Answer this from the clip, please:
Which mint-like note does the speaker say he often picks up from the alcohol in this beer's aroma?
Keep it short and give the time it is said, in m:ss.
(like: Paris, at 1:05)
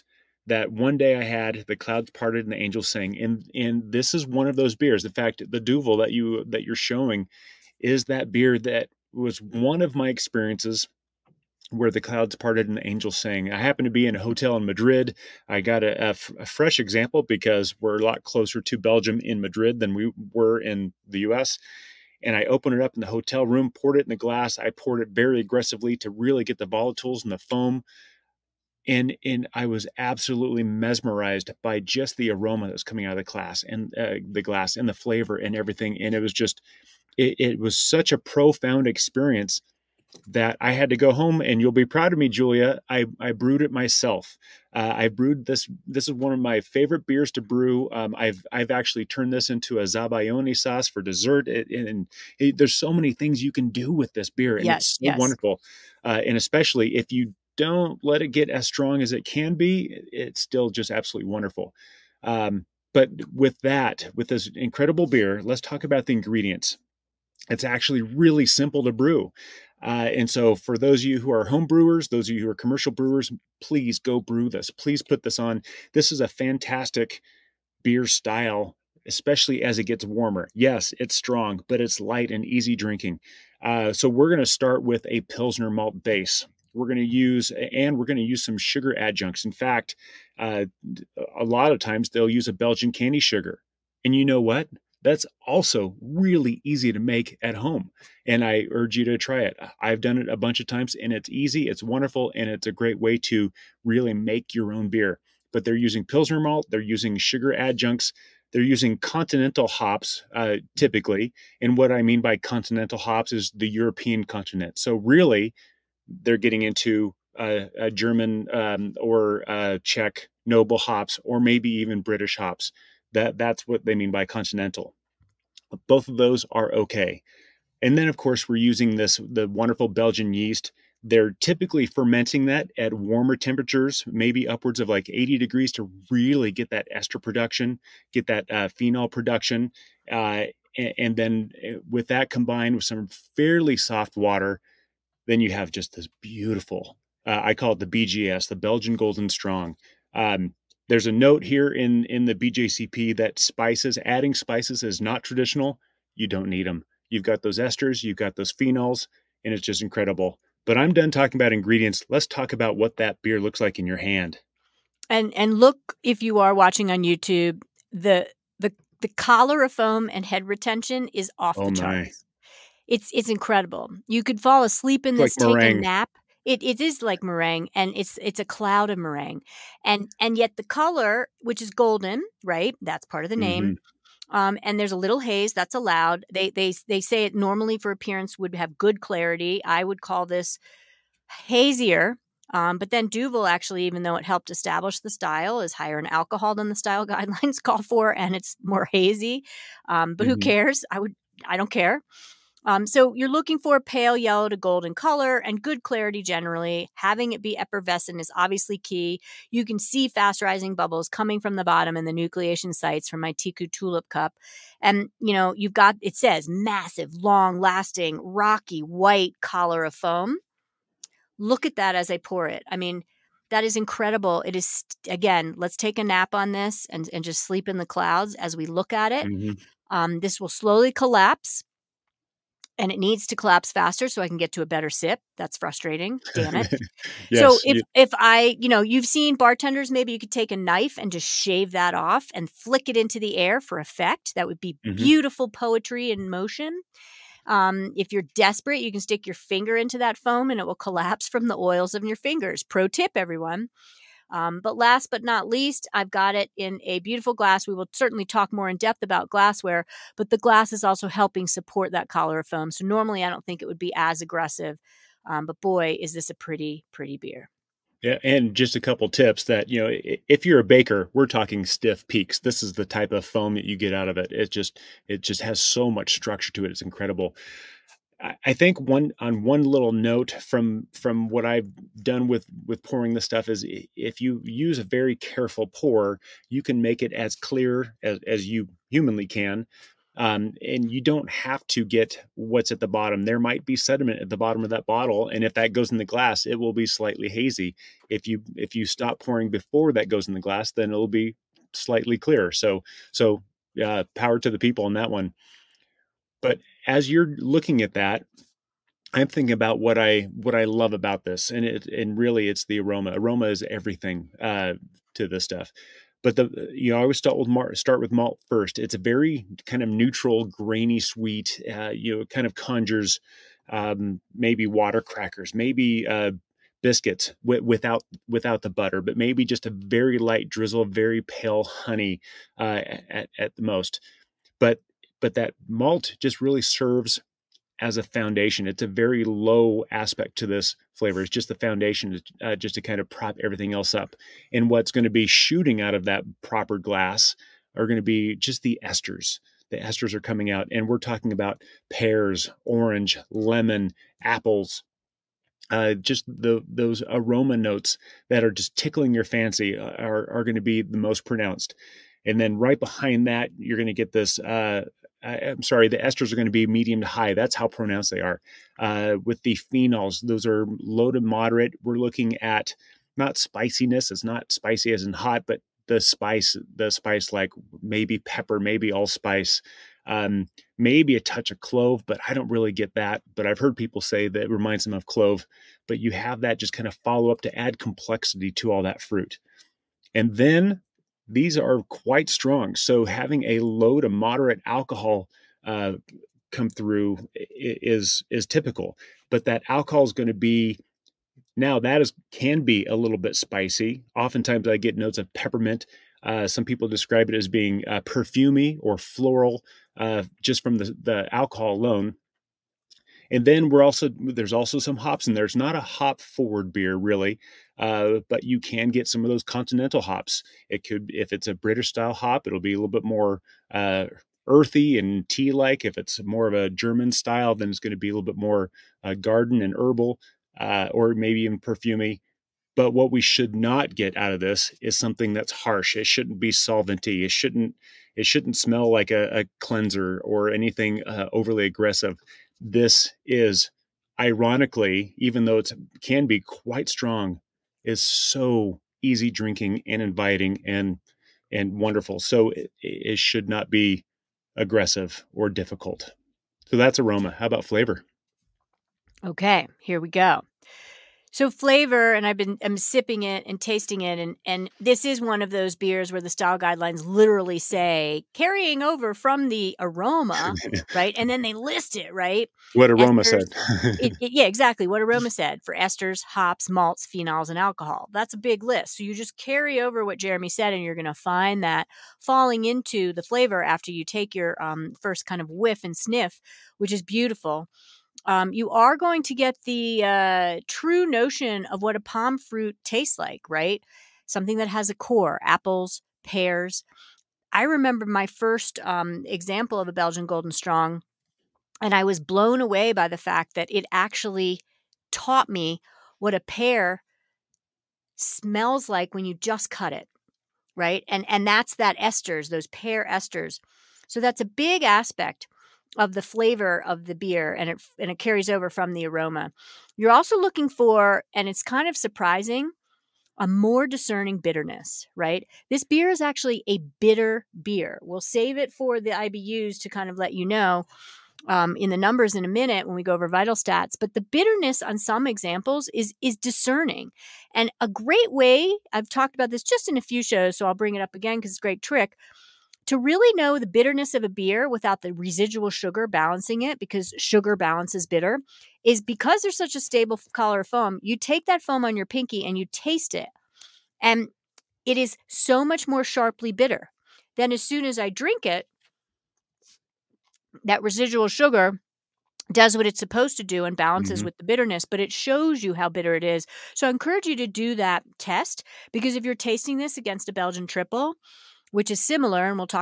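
peppermint, at 6:45.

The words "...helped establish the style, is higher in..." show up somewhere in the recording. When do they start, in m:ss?
3:14.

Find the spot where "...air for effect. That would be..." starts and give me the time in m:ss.
4:03.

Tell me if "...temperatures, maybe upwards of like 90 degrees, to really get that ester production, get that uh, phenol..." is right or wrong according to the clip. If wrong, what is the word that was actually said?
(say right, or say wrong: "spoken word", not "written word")
wrong: "80", not "90".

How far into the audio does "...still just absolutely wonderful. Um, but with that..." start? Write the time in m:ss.
1:00.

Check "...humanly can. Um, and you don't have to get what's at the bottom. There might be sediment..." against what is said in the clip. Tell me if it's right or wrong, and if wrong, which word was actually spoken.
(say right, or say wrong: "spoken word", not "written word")
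right.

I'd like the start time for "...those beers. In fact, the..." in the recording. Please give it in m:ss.
0:04.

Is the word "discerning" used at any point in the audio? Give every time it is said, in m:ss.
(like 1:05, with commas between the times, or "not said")
8:43, 8:56.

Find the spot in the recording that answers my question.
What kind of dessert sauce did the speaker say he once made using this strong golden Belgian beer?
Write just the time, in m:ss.
0:49.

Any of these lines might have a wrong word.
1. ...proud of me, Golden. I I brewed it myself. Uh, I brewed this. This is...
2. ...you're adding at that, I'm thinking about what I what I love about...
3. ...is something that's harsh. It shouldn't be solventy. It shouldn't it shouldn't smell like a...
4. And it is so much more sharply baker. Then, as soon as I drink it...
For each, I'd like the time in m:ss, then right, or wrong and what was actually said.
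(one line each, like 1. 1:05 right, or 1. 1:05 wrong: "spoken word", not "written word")
1. 0:41 wrong: "Julia", not "Golden"
2. 5:07 wrong: "looking", not "adding"
3. 7:14 right
4. 9:14 wrong: "bitter", not "baker".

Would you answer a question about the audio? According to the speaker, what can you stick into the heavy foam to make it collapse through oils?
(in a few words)
your finger.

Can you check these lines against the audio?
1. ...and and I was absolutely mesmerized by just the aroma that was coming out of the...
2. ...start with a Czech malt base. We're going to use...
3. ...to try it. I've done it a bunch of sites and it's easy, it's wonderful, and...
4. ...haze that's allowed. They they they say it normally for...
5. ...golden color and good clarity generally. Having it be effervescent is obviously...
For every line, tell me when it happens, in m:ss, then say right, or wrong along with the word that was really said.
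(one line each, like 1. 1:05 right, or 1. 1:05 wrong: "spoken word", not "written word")
1. 0:28 right
2. 1:24 wrong: "Pilsner", not "Czech"
3. 1:39 wrong: "times", not "sites"
4. 3:05 right
5. 3:24 right.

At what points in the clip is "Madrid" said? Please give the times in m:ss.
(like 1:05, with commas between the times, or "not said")
0:14, 0:19.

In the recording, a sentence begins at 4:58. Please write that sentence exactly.
If you if you stop pouring before that goes in the glass, then it'll be slightly clearer.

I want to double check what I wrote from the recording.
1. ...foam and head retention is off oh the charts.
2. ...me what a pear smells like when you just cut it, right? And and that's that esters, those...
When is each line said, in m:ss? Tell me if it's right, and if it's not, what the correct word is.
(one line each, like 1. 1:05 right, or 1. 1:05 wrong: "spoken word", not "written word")
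1. 2:49 right
2. 8:25 right.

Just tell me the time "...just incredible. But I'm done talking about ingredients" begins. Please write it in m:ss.
2:39.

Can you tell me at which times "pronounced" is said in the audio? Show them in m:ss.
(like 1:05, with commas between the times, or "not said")
6:01, 6:07.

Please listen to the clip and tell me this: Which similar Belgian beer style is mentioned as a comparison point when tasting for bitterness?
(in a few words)
Belgian triple.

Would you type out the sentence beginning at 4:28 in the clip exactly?
Yeah, and just a couple tips that you know, if you're a baker, we're talking stiff peaks.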